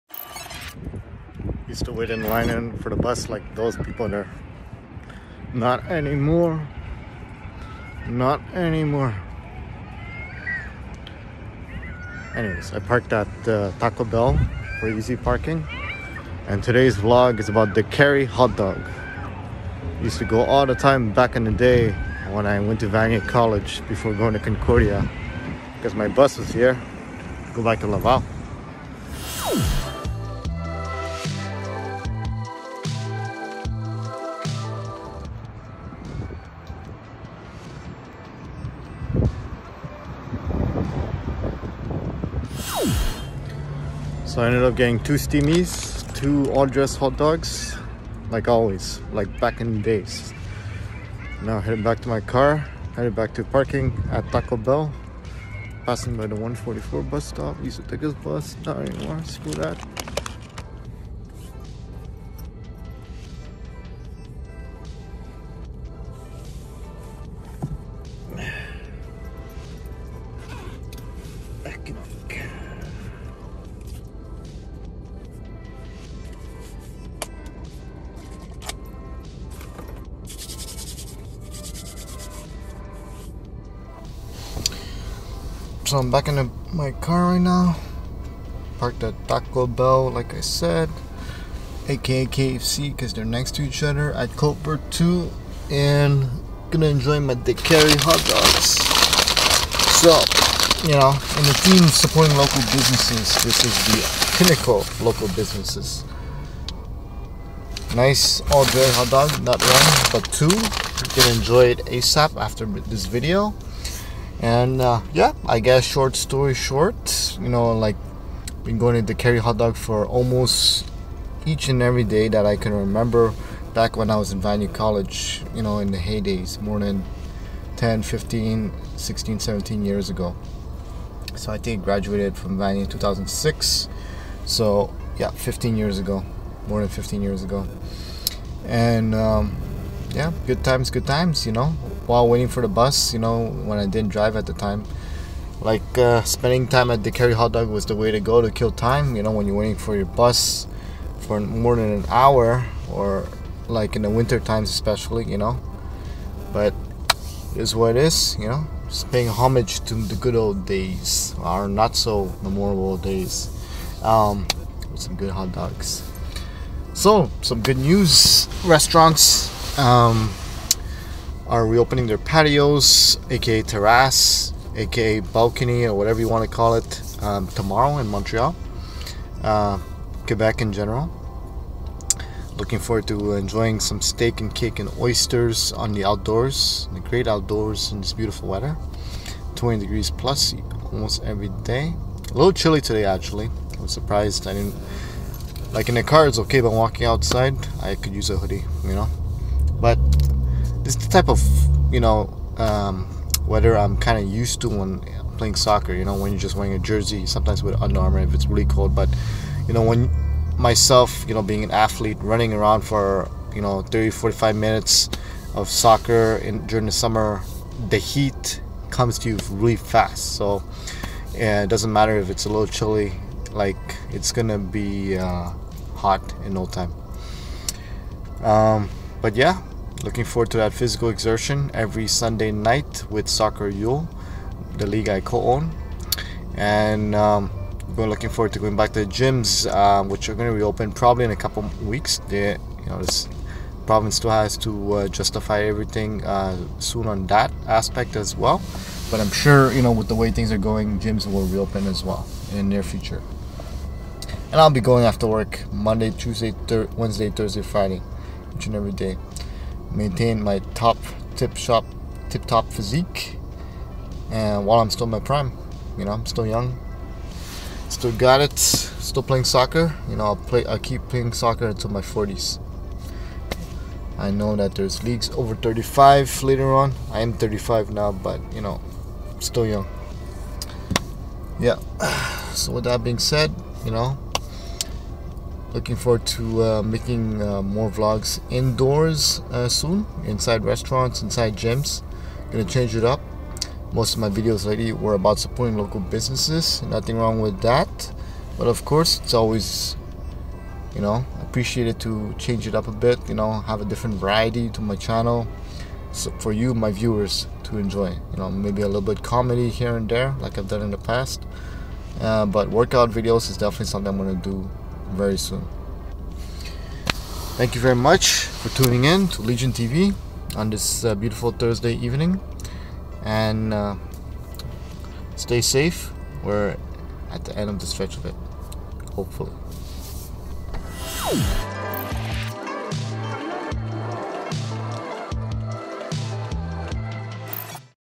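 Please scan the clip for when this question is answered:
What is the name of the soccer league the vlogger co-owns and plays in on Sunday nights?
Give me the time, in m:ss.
3:53.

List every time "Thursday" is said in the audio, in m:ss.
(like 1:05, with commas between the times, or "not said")
4:17, 5:21.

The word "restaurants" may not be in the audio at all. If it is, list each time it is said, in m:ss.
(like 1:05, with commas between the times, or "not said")
2:48, 4:50.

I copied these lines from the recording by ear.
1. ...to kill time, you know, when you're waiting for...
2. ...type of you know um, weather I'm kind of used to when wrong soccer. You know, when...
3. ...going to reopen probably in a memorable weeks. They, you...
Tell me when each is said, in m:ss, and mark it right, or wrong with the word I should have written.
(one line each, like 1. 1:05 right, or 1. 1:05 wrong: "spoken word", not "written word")
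1. 2:28 right
2. 3:21 wrong: "playing", not "wrong"
3. 4:00 wrong: "couple", not "memorable".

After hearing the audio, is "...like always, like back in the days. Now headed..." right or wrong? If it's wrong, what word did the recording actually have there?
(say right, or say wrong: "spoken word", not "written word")
right.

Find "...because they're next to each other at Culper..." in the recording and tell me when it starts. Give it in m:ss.
1:32.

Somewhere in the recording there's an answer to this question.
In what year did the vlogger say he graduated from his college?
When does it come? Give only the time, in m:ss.
2:12.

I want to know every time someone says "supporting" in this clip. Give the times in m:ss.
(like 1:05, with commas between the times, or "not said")
1:41, 4:55.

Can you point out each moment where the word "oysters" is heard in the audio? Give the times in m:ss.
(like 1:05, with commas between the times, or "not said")
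3:04.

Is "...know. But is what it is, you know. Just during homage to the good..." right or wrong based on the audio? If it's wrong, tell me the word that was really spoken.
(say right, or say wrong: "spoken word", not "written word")
wrong: "paying", not "during".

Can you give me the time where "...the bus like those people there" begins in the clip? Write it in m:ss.
0:02.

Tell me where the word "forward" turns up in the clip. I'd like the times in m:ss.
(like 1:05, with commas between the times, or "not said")
3:02, 3:50, 3:58, 4:45.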